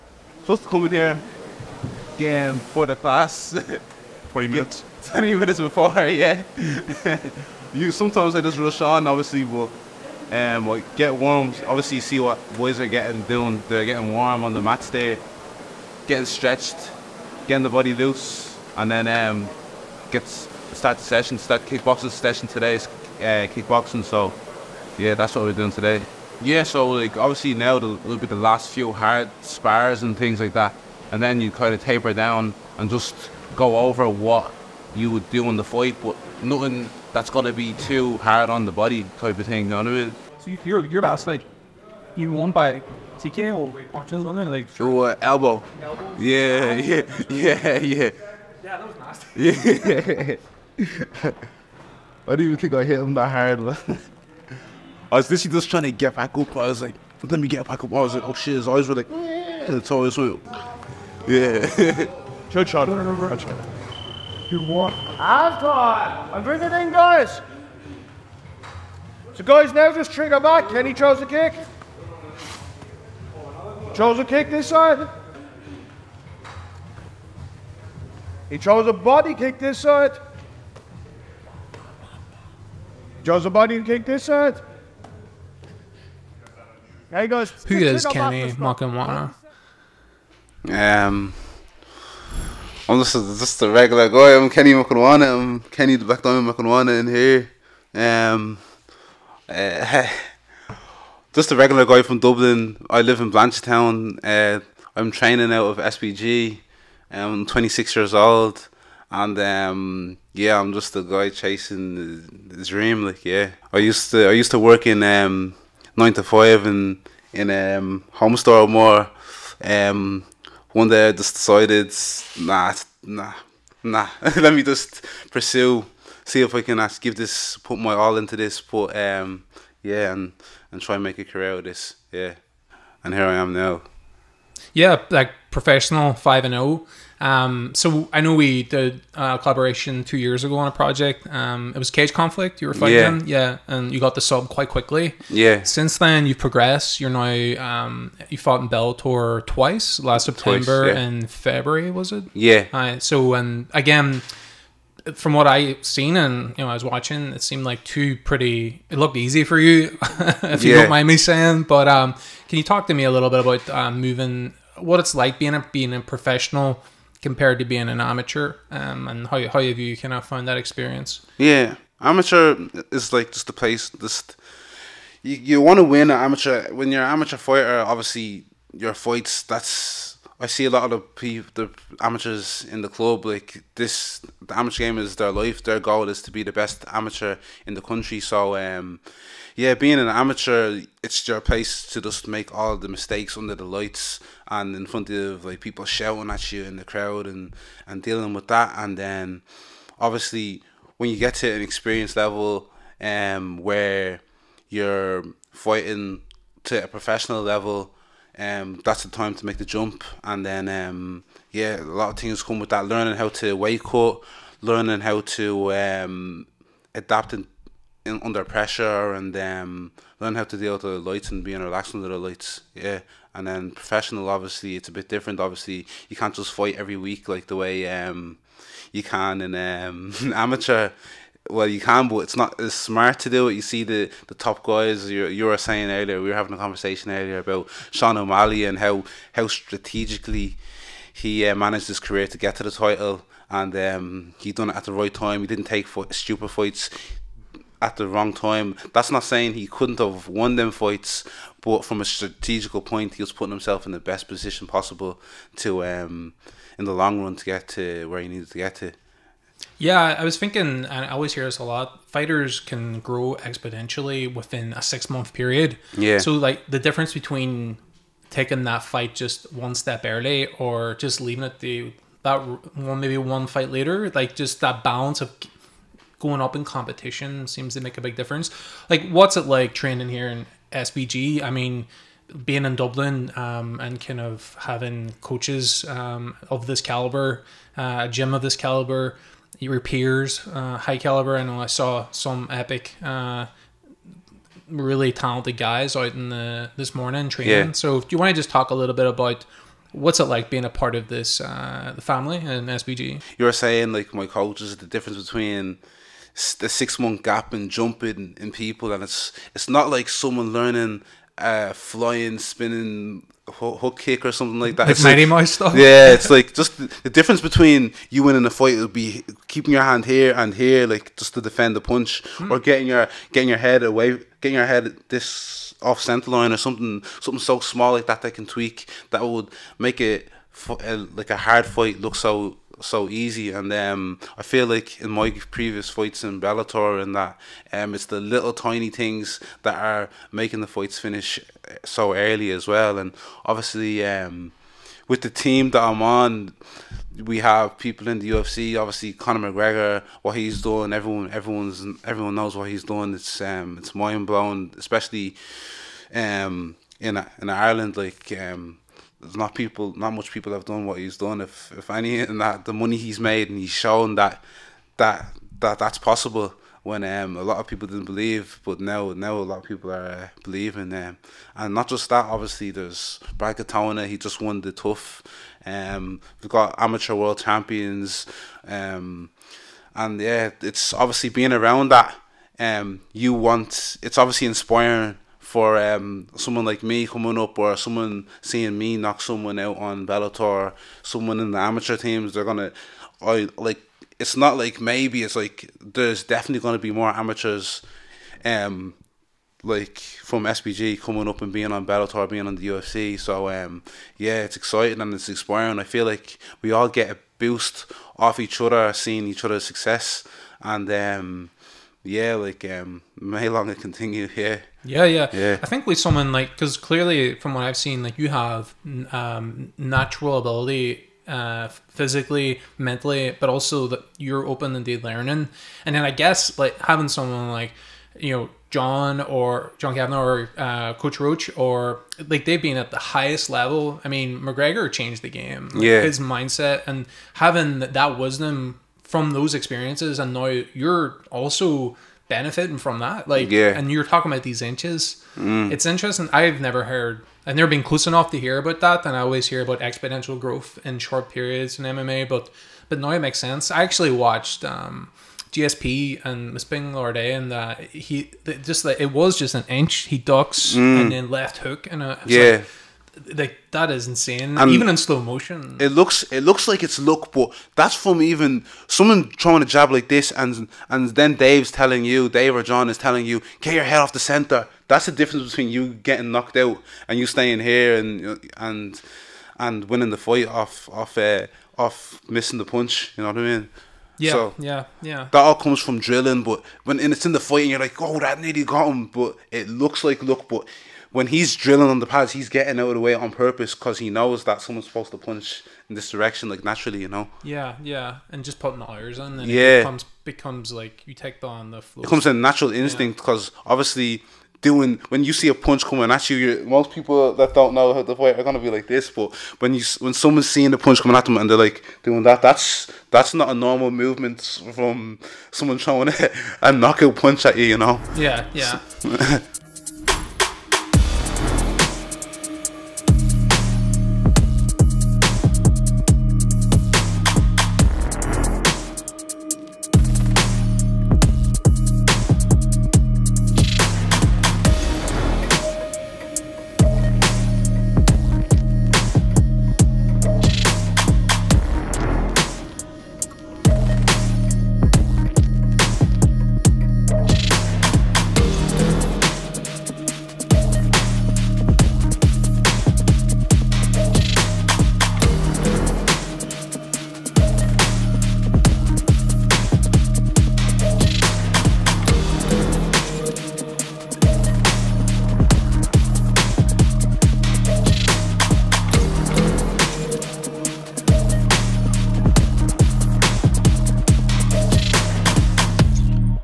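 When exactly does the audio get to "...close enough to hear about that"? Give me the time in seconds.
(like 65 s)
447 s.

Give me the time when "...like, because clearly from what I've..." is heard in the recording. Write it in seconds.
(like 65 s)
416 s.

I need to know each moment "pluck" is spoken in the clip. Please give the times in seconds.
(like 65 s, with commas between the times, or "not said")
not said.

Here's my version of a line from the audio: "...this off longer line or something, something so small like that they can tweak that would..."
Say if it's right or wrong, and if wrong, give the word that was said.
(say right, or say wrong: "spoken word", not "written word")
wrong: "center", not "longer".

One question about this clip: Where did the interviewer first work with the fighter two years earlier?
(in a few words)
Cage Conflict.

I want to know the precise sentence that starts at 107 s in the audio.
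I'm 26 years old, and um, yeah, I'm just a guy chasing the dream.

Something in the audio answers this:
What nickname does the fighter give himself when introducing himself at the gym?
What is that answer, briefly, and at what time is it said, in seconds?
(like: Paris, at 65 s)
The Backdown, at 95 s.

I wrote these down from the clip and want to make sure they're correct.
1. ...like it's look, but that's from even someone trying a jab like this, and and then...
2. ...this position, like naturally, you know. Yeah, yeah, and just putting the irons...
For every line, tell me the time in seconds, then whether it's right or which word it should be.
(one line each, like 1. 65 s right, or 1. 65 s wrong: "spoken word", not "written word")
1. 466 s right
2. 495 s wrong: "direction", not "position".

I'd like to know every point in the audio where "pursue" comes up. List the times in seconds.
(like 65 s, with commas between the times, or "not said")
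125 s.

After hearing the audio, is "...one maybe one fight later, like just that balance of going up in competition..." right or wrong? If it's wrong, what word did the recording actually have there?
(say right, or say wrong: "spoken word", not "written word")
right.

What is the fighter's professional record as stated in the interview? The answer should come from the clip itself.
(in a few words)
5-0.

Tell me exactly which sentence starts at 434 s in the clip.
I mean, McGregor changed the game.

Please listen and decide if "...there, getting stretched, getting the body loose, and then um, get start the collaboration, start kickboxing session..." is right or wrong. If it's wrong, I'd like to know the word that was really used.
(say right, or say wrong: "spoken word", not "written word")
wrong: "session", not "collaboration".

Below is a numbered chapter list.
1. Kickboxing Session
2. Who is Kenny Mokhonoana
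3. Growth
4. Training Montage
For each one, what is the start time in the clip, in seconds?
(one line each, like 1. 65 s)
1. 65 s
2. 88 s
3. 259 s
4. 519 s.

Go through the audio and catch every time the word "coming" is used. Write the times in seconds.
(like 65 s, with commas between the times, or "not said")
387 s, 400 s, 505 s, 511 s.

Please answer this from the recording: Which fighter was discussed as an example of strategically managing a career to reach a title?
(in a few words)
Sean O'Malley.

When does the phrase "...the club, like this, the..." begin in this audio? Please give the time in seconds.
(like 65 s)
182 s.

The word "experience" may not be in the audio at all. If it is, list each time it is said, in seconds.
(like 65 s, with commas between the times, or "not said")
170 s, 201 s, 439 s.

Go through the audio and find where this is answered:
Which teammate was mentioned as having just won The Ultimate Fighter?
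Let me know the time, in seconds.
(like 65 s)
373 s.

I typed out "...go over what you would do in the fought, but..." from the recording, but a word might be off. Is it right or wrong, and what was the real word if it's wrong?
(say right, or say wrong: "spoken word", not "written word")
wrong: "fight", not "fought".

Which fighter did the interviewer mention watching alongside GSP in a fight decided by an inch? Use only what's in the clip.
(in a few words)
Bisping.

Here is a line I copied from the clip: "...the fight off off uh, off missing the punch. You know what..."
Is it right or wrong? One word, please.
right.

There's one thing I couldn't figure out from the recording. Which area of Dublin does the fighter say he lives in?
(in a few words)
Blanchardstown.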